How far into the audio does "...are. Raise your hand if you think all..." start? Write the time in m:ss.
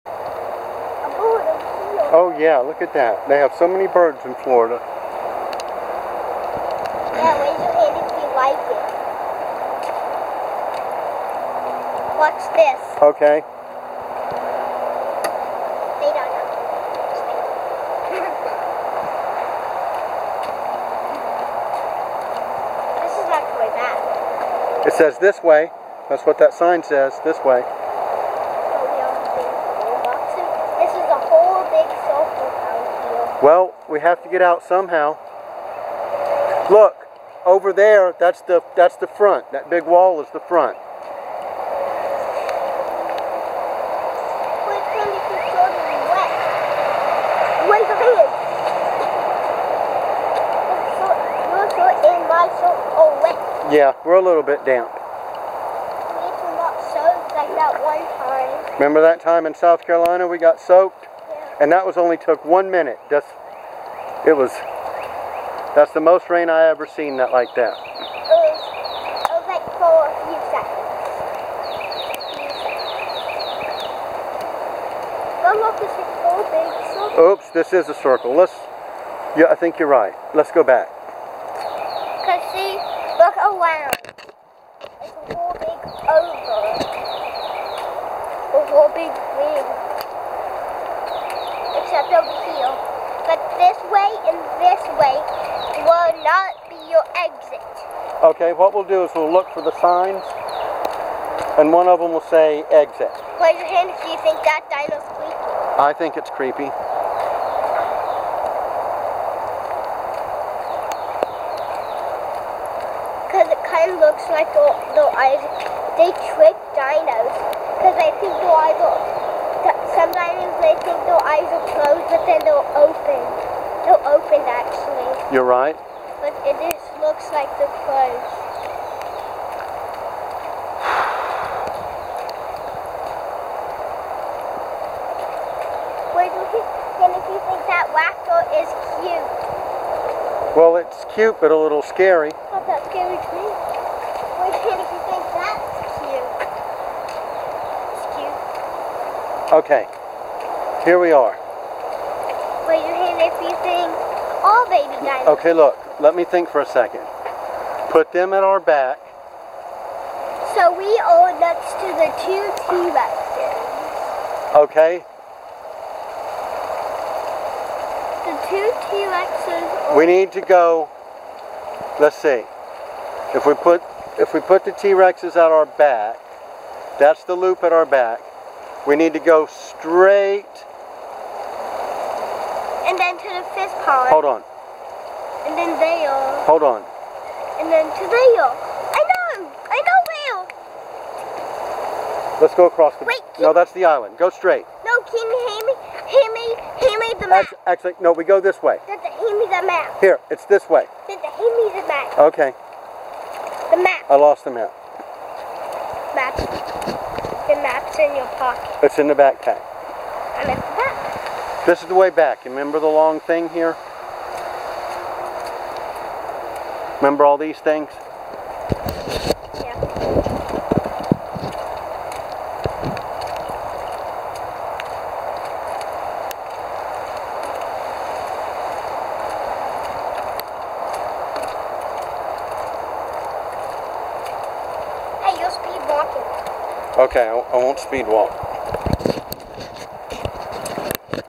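2:31.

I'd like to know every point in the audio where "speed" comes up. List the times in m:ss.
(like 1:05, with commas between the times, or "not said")
3:57.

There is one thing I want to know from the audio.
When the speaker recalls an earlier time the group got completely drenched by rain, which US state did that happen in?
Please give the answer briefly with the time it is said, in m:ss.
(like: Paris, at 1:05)
South Carolina, at 0:59.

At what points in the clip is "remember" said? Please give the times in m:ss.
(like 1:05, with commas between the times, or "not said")
0:58, 3:32, 3:37.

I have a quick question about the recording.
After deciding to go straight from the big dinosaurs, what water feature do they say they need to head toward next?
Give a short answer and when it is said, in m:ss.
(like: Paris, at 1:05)
the fish pond, at 3:03.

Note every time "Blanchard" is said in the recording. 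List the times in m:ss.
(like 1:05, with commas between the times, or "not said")
not said.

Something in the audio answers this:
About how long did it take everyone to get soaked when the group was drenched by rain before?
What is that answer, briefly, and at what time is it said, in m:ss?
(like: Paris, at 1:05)
1 minute, at 1:02.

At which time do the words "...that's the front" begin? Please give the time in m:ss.
0:38.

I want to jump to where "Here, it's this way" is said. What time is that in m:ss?
3:20.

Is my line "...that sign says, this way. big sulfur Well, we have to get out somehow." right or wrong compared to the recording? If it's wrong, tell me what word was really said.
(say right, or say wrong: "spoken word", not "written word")
right.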